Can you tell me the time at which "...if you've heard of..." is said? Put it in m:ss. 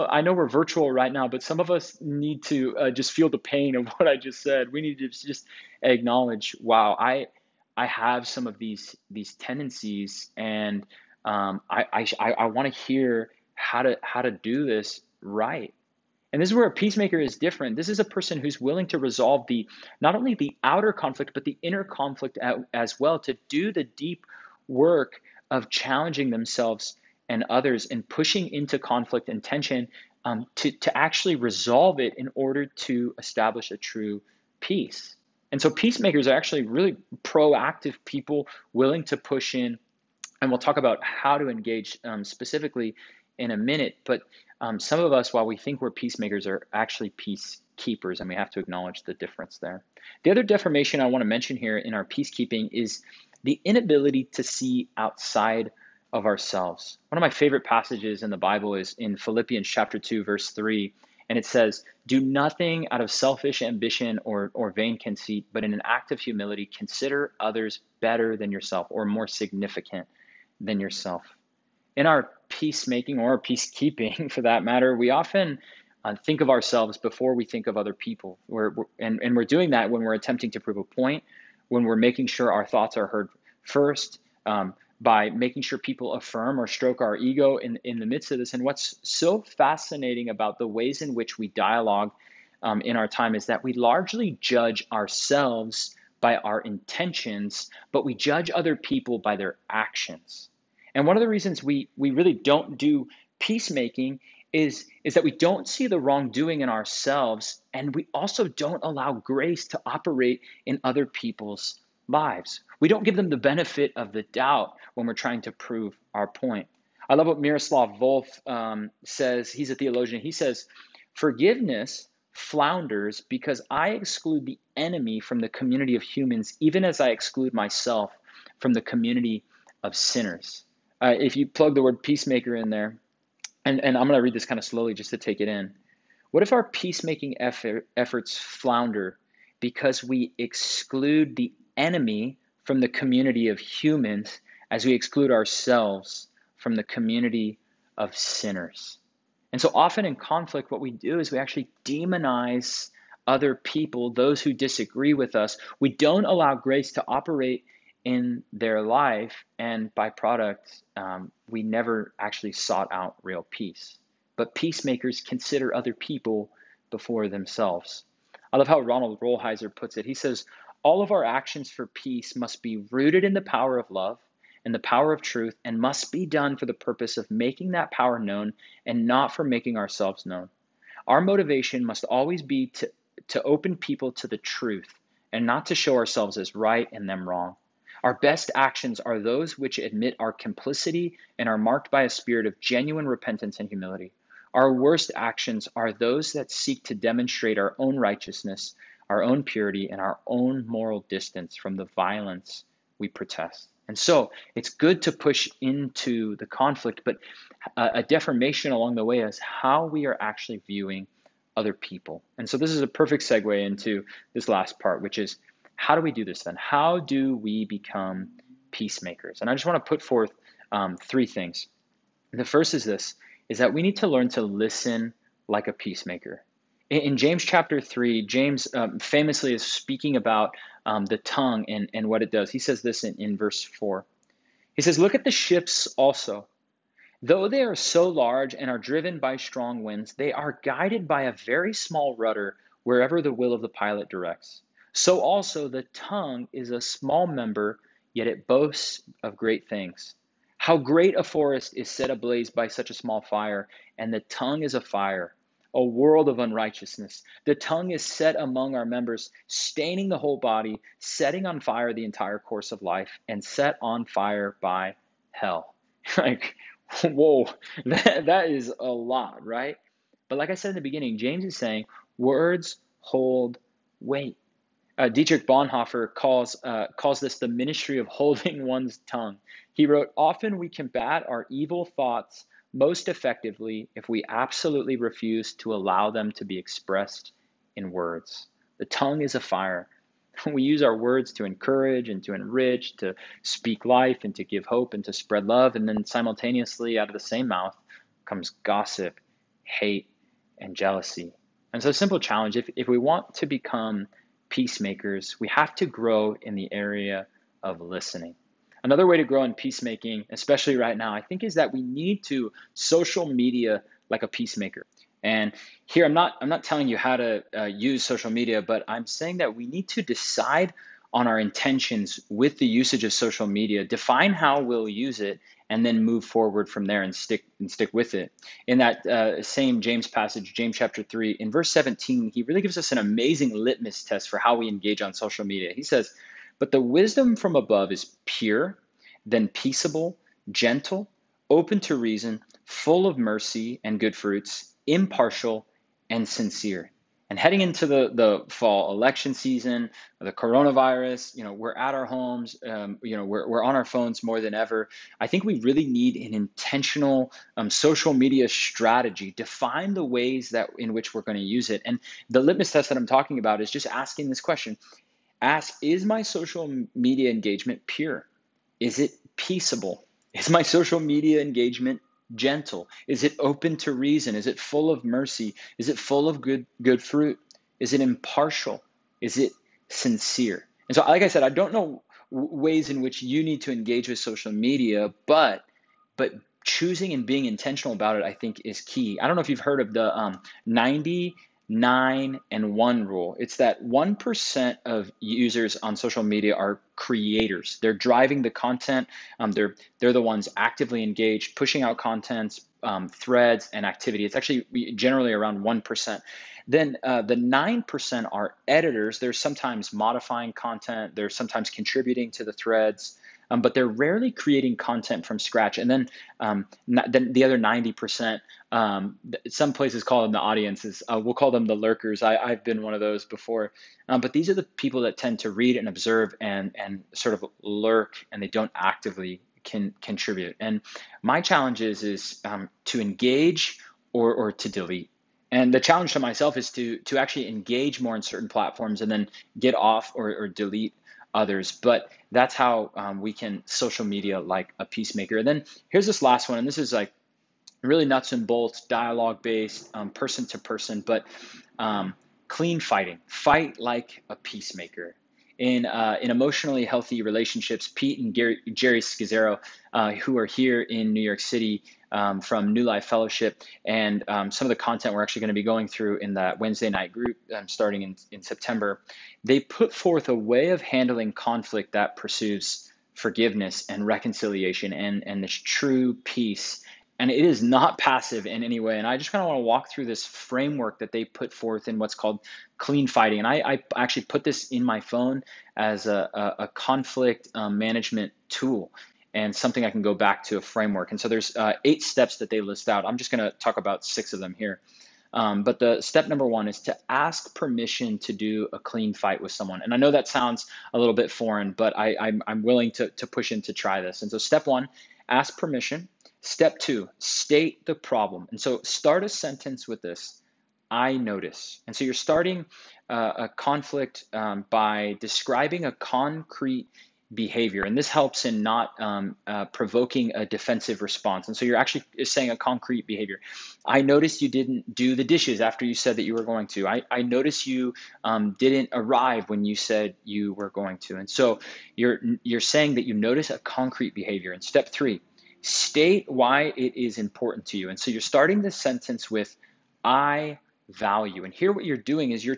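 6:29.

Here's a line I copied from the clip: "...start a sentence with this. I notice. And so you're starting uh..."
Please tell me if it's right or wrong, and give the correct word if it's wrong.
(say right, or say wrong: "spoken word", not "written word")
right.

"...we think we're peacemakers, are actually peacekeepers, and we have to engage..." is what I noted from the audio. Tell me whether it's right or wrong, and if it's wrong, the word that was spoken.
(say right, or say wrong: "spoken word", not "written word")
wrong: "acknowledge", not "engage".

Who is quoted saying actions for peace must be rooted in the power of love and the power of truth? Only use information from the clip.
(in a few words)
Ronald Rolheiser.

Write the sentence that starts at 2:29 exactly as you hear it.
And so often in conflict, what we do is we actually demonize other people, those who disagree with us.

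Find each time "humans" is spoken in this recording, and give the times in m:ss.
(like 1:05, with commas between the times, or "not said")
2:06, 2:23.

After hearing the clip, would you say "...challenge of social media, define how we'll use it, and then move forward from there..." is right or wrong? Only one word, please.
wrong.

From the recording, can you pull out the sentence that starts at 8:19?
And I know that sounds a little bit foreign, but I, I'm, I'm willing to, to push in to try this.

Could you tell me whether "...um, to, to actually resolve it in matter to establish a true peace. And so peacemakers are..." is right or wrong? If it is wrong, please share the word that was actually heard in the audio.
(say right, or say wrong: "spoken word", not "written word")
wrong: "order", not "matter".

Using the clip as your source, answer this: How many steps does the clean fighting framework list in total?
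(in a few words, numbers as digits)
8.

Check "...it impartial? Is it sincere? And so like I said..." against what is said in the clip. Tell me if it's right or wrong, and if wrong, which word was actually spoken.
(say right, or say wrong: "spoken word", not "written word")
right.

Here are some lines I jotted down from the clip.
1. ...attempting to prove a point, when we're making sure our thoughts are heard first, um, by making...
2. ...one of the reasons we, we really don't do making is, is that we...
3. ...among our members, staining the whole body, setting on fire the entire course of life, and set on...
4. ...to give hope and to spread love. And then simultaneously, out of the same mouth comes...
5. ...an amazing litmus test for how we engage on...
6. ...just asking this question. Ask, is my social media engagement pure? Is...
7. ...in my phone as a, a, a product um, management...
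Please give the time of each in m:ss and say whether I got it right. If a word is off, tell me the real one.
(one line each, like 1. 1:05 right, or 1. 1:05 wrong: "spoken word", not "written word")
1. 1:20 right
2. 1:41 wrong: "peacemaking", not "making"
3. 4:18 right
4. 4:54 right
5. 5:32 right
6. 6:03 right
7. 8:04 wrong: "conflict", not "product".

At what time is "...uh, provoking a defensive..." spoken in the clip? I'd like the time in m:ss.
8:39.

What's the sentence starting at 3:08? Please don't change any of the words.
Our best actions are those which admit our complicity and are marked by a spirit of genuine repentance and humility.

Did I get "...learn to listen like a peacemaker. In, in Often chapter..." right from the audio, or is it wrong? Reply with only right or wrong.
wrong.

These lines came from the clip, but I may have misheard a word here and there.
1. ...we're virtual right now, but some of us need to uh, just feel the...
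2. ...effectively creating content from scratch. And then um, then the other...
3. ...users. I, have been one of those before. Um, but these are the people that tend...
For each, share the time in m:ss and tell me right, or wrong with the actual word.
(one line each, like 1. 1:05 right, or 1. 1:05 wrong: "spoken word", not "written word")
1. 0:00 right
2. 6:53 wrong: "rarely", not "effectively"
3. 7:01 wrong: "lurkers", not "users".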